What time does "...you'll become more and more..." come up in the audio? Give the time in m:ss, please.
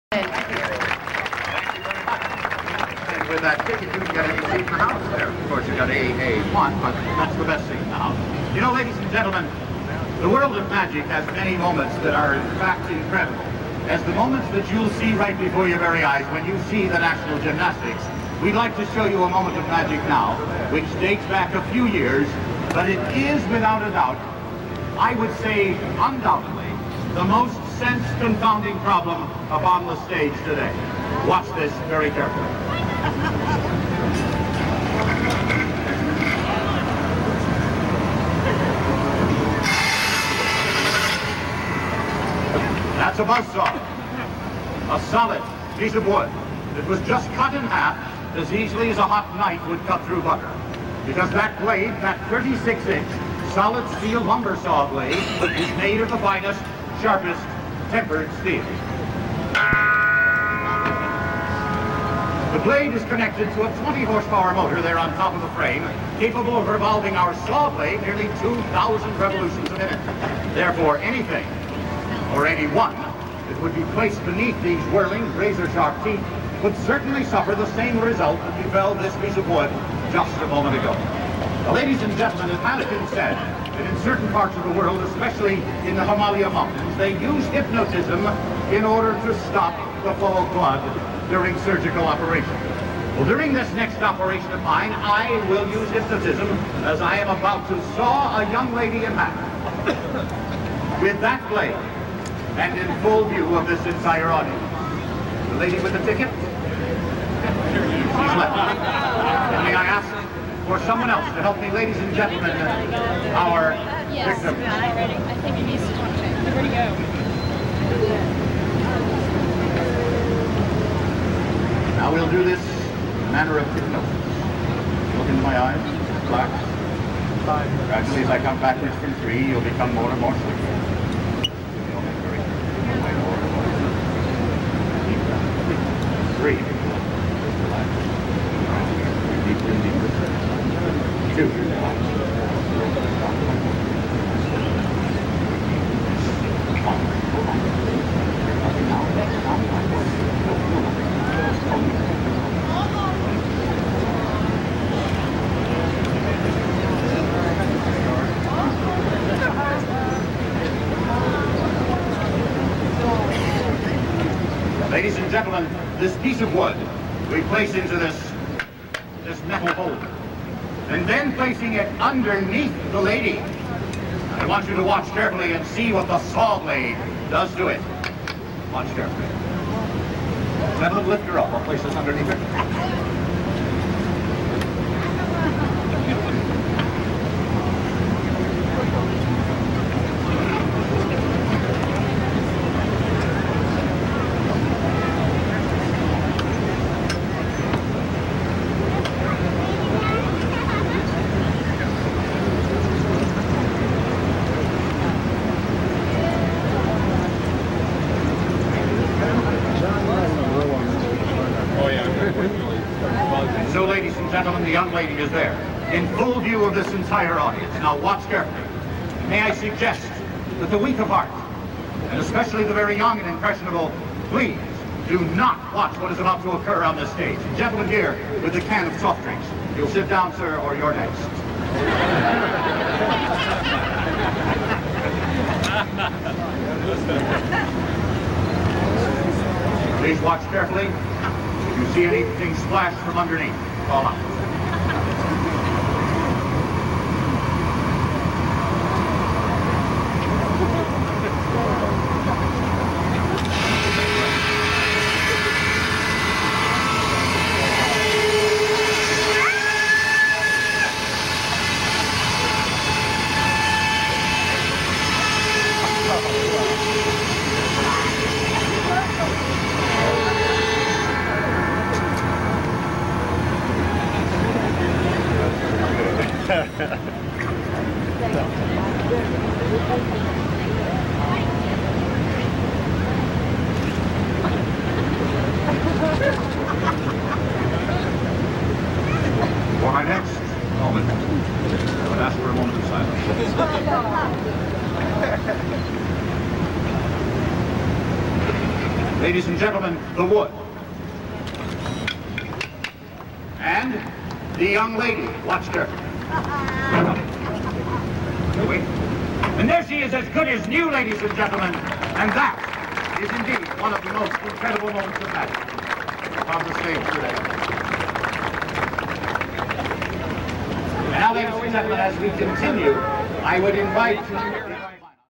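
2:09.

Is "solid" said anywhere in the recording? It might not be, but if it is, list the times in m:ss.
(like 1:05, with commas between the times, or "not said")
0:45, 0:53.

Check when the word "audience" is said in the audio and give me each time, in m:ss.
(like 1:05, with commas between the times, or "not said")
1:44, 3:37.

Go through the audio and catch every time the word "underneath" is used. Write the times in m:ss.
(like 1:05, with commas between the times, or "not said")
2:52, 3:01, 4:03.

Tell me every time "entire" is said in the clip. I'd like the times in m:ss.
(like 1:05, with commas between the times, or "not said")
1:43, 3:36.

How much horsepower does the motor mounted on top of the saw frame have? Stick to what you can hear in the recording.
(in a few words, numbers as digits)
20.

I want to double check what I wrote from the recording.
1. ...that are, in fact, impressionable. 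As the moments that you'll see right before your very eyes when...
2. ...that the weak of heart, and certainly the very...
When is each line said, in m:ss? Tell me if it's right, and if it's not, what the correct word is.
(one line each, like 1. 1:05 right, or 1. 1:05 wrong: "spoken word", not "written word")
1. 0:12 wrong: "incredible", not "impressionable"
2. 3:40 wrong: "especially", not "certainly".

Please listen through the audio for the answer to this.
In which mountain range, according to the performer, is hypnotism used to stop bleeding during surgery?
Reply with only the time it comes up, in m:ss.
1:26.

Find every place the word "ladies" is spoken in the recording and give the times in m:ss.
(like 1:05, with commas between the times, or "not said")
0:08, 1:21, 1:51, 2:44, 3:33, 4:59, 5:10, 5:21.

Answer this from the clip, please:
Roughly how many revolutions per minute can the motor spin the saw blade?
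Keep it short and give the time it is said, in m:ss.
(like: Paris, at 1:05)
2,000, at 1:08.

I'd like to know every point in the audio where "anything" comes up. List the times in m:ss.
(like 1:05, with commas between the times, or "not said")
1:10, 4:02.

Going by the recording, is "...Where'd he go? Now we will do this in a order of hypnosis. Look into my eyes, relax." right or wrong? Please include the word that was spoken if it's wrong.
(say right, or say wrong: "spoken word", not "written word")
wrong: "manner", not "order".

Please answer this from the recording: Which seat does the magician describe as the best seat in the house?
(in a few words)
AA1.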